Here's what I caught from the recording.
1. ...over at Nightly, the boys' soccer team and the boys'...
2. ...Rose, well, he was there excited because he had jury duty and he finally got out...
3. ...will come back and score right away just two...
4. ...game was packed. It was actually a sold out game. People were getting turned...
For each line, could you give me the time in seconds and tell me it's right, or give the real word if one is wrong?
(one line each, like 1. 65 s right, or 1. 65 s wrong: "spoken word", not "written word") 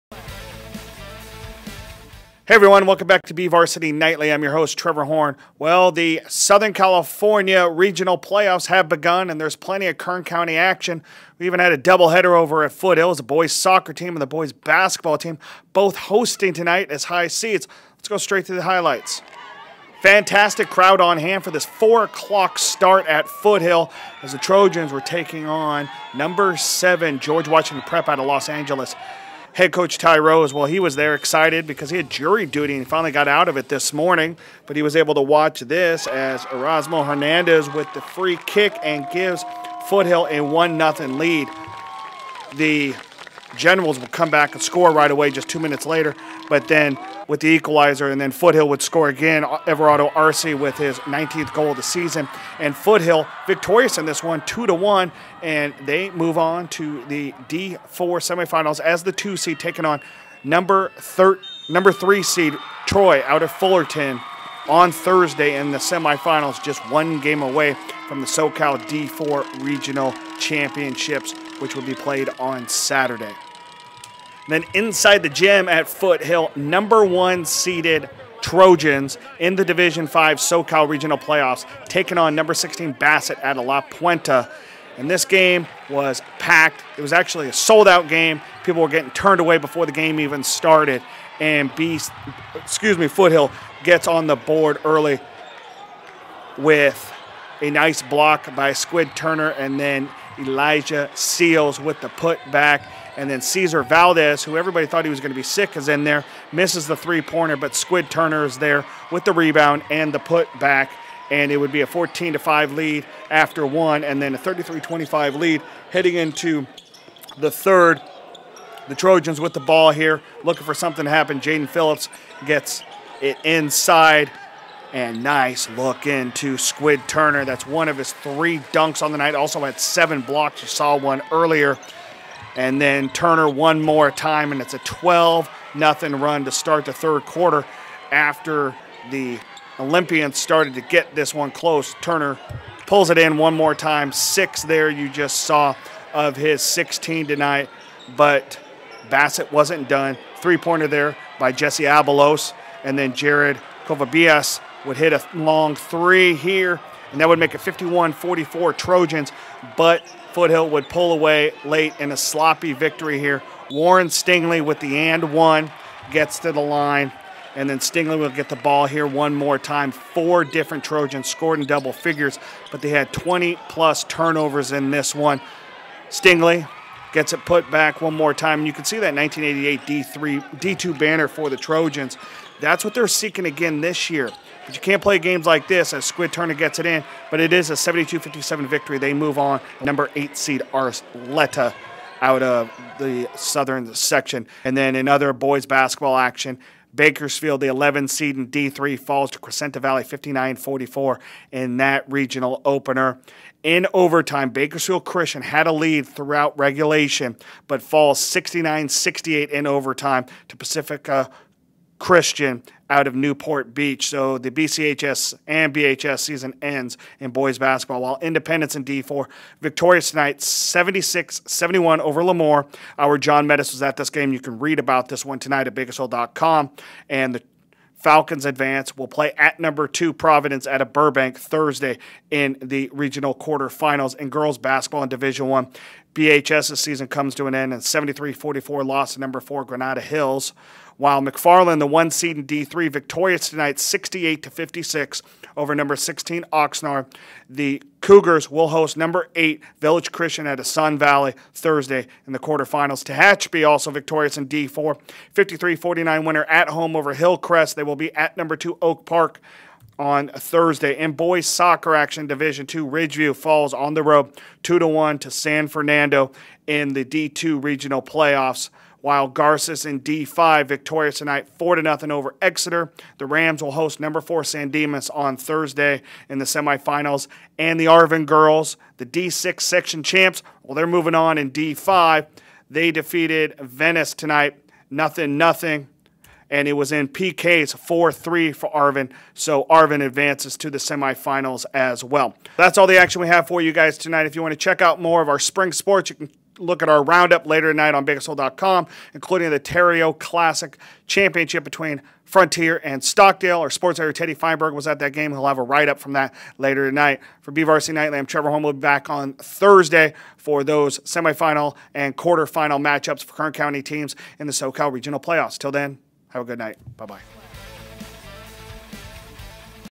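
1. 12 s wrong: "Foothills", not "Nightly"
2. 30 s right
3. 43 s right
4. 85 s right.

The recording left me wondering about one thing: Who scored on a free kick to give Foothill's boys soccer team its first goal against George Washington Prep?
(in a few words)
Erasmo Hernandez.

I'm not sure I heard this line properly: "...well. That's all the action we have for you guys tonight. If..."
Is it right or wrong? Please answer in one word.
right.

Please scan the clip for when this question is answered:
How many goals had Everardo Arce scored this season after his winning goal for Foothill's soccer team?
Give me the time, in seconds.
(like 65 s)
50 s.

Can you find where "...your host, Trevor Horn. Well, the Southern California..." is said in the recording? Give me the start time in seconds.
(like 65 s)
4 s.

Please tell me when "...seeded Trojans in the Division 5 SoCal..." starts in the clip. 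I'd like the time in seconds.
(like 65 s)
77 s.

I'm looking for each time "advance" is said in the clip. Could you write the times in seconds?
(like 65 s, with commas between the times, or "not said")
228 s, 290 s.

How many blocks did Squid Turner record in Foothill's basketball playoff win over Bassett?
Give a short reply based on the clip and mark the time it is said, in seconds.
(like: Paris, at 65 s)
7, at 129 s.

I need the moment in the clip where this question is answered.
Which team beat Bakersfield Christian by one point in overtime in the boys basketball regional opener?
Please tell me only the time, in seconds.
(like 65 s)
210 s.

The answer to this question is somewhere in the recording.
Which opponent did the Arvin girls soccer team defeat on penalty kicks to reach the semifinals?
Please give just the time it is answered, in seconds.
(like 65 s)
283 s.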